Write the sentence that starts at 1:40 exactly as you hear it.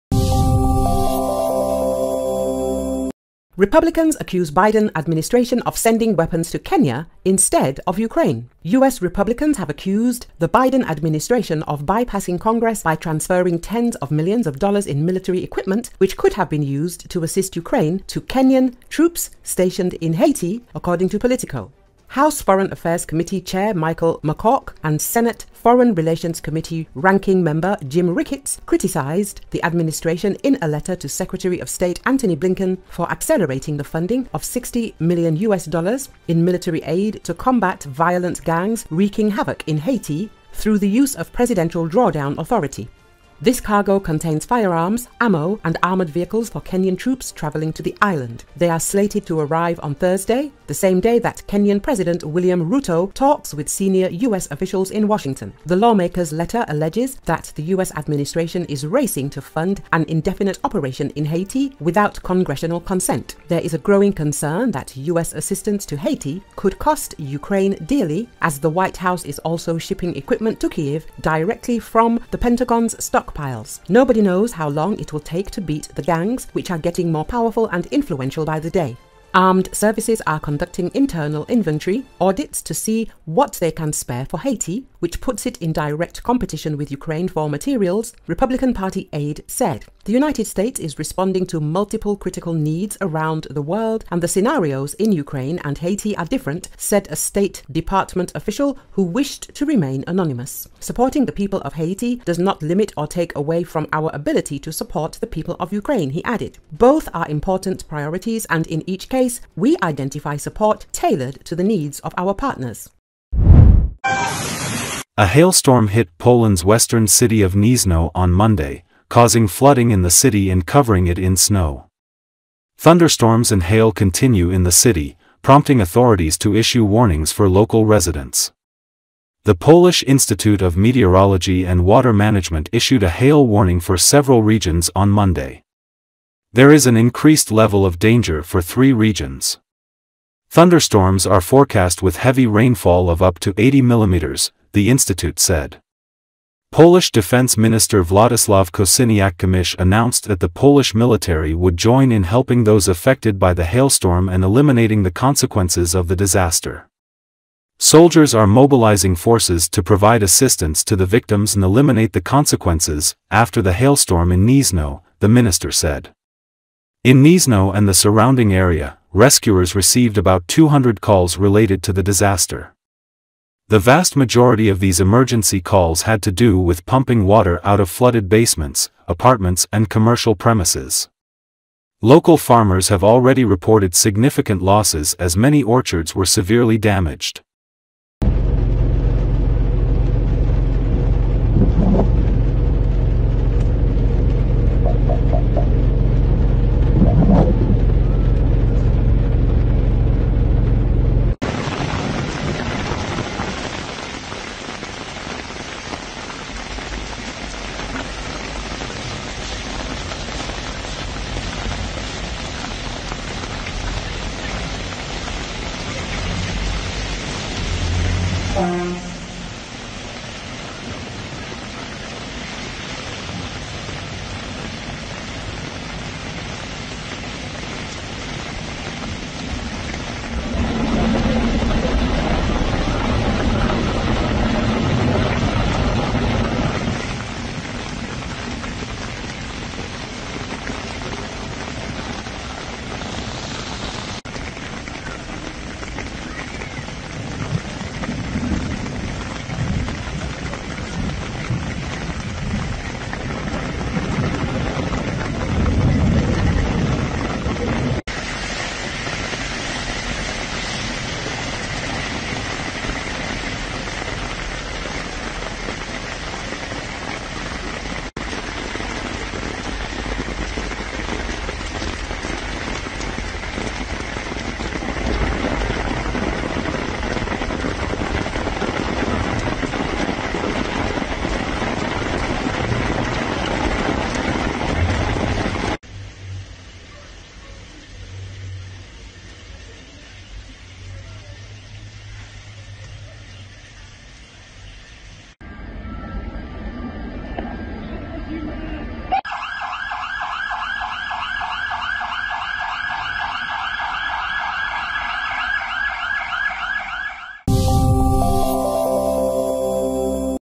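Supporting the people of Haiti does not limit or take away from our ability to support the people of Ukraine, he added.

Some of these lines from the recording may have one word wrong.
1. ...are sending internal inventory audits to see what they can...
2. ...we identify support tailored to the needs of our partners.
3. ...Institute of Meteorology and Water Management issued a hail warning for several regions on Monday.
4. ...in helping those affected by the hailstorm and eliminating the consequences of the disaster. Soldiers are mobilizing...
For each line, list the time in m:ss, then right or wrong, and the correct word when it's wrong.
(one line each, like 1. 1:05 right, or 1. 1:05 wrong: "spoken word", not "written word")
1. 1:20 wrong: "conducting", not "sending"
2. 1:49 right
3. 2:10 right
4. 2:32 right.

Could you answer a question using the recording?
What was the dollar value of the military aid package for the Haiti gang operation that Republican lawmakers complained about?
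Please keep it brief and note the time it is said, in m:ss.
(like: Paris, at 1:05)
$60 million, at 0:34.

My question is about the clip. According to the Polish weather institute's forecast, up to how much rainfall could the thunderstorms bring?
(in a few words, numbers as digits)
80 millimeters.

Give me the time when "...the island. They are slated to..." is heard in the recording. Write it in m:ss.
0:47.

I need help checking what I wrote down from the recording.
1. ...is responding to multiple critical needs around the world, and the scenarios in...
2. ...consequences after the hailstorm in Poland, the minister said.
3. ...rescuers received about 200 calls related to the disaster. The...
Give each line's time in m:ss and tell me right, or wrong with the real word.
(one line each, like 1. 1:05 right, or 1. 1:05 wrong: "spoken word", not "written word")
1. 1:30 right
2. 2:42 wrong: "Gniezno", not "Poland"
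3. 2:49 right.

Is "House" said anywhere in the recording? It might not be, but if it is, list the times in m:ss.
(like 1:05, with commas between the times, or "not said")
0:22, 1:08.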